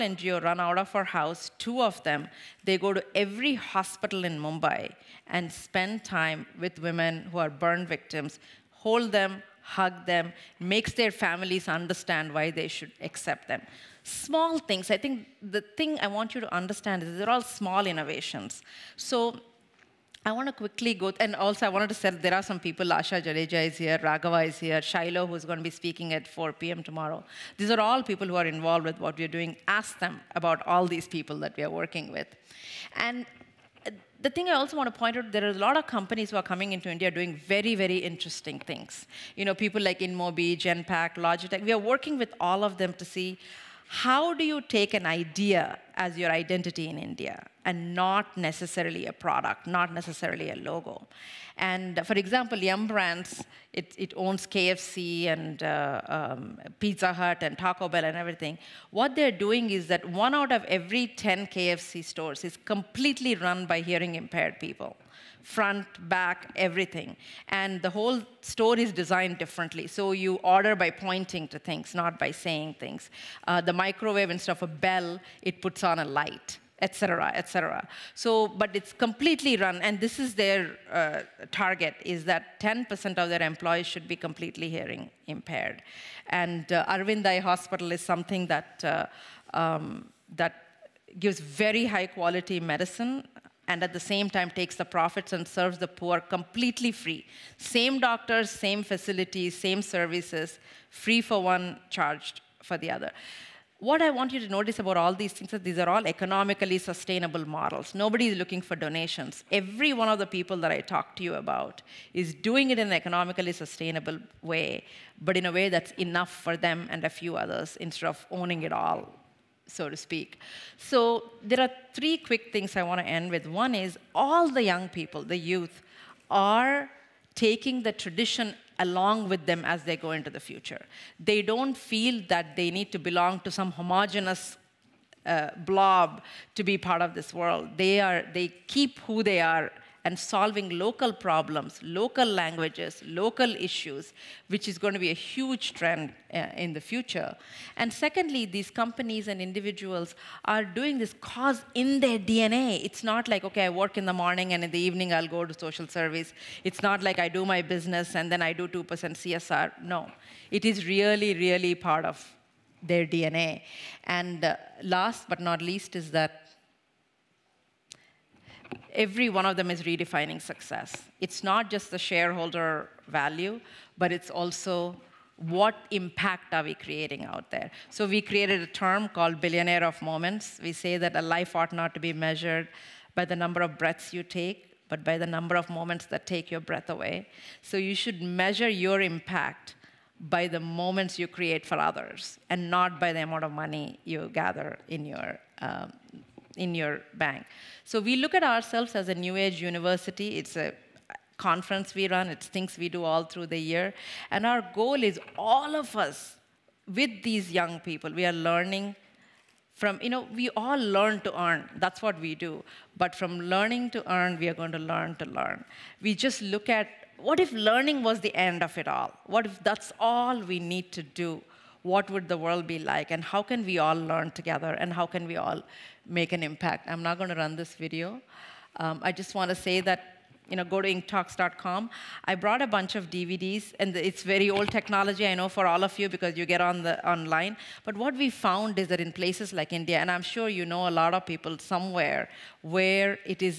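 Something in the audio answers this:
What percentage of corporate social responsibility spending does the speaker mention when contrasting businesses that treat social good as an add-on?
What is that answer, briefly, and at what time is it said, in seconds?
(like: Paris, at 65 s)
2%, at 158 s.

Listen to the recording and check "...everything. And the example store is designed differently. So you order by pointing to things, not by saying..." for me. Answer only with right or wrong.
wrong.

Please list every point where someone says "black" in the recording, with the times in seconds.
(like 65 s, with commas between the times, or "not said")
not said.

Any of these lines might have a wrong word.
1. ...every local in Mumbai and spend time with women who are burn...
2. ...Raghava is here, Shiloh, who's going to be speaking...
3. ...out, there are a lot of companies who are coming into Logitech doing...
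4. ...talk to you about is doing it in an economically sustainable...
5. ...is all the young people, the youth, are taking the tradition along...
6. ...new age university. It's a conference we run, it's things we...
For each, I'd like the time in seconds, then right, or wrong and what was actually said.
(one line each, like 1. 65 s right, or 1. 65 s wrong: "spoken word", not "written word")
1. 3 s wrong: "hospital", not "local"
2. 23 s right
3. 35 s wrong: "India", not "Logitech"
4. 110 s right
5. 123 s right
6. 199 s right.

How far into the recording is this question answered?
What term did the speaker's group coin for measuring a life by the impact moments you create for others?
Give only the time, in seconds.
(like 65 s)
179 s.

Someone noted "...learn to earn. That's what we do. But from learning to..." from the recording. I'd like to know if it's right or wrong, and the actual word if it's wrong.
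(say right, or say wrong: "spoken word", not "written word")
right.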